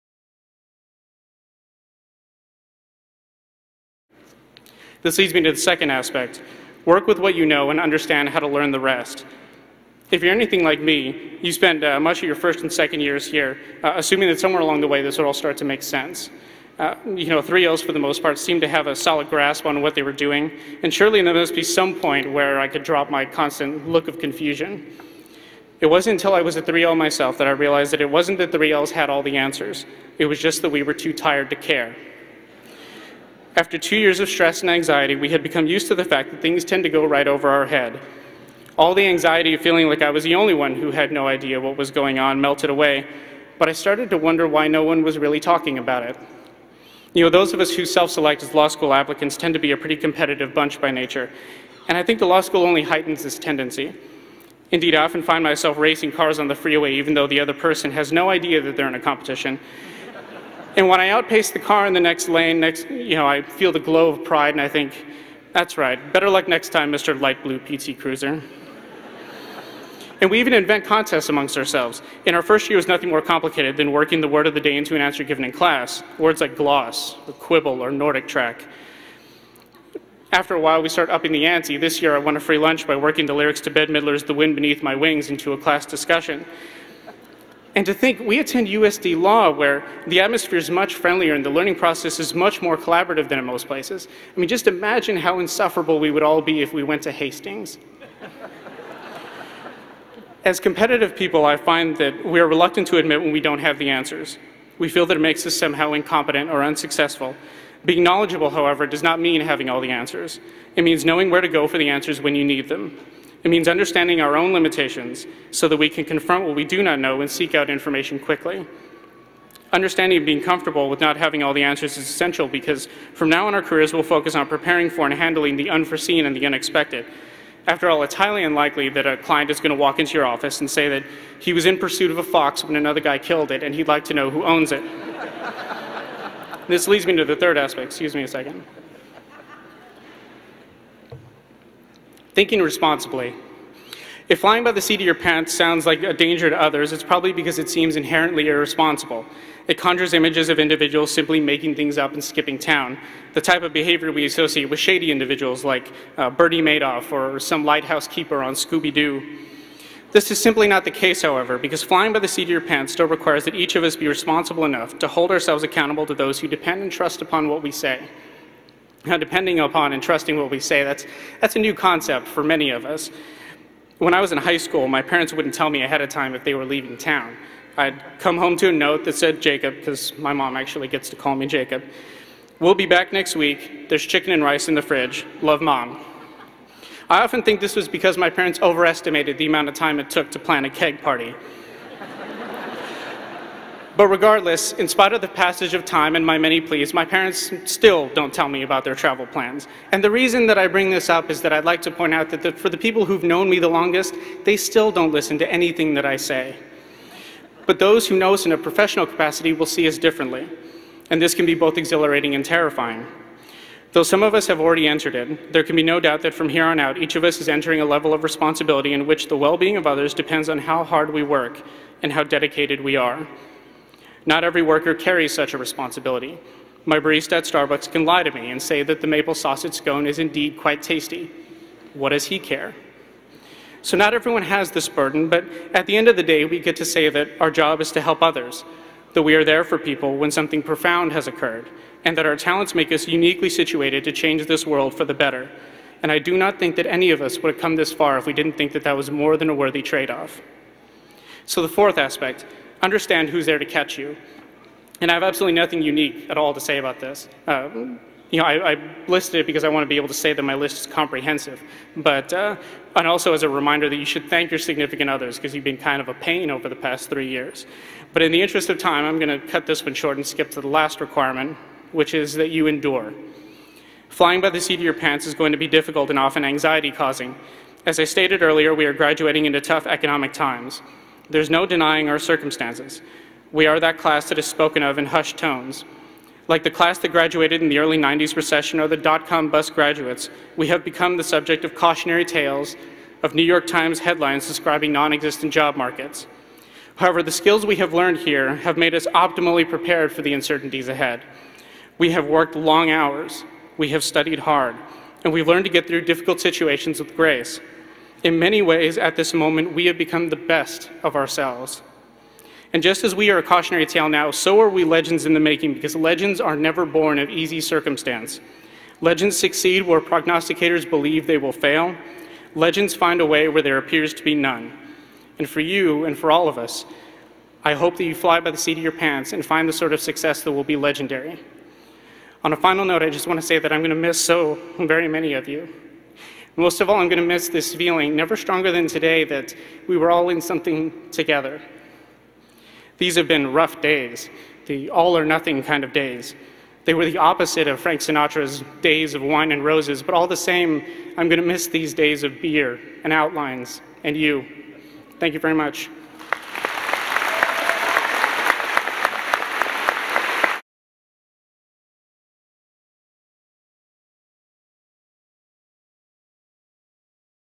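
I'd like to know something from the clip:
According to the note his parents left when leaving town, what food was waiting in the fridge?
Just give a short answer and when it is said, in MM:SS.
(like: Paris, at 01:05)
Chicken and rice, at 03:04.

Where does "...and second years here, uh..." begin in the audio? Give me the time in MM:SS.
00:12.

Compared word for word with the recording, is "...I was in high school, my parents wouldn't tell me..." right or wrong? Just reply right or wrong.
right.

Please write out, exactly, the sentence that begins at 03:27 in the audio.
But those who know us in a professional capacity will see us differently.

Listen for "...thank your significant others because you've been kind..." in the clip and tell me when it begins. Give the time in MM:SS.
04:24.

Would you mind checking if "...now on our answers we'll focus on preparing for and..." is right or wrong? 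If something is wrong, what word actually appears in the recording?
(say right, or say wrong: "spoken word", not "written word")
wrong: "careers", not "answers".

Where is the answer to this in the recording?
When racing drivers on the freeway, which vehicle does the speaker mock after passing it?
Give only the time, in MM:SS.
01:07.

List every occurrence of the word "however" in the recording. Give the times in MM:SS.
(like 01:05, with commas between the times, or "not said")
01:48, 02:41, 04:56.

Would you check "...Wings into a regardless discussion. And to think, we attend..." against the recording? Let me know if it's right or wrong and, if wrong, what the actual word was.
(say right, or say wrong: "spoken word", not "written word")
wrong: "class", not "regardless".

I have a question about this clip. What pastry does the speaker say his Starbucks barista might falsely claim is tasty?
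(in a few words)
Maple sausage scone.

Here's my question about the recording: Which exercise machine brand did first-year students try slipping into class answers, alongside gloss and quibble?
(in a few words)
Nordic track.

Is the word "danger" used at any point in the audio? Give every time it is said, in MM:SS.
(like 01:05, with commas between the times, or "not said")
02:26.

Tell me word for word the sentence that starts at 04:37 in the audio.
As I stated earlier, we are graduating into tough economic times.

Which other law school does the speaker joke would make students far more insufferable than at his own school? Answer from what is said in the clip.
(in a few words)
Hastings.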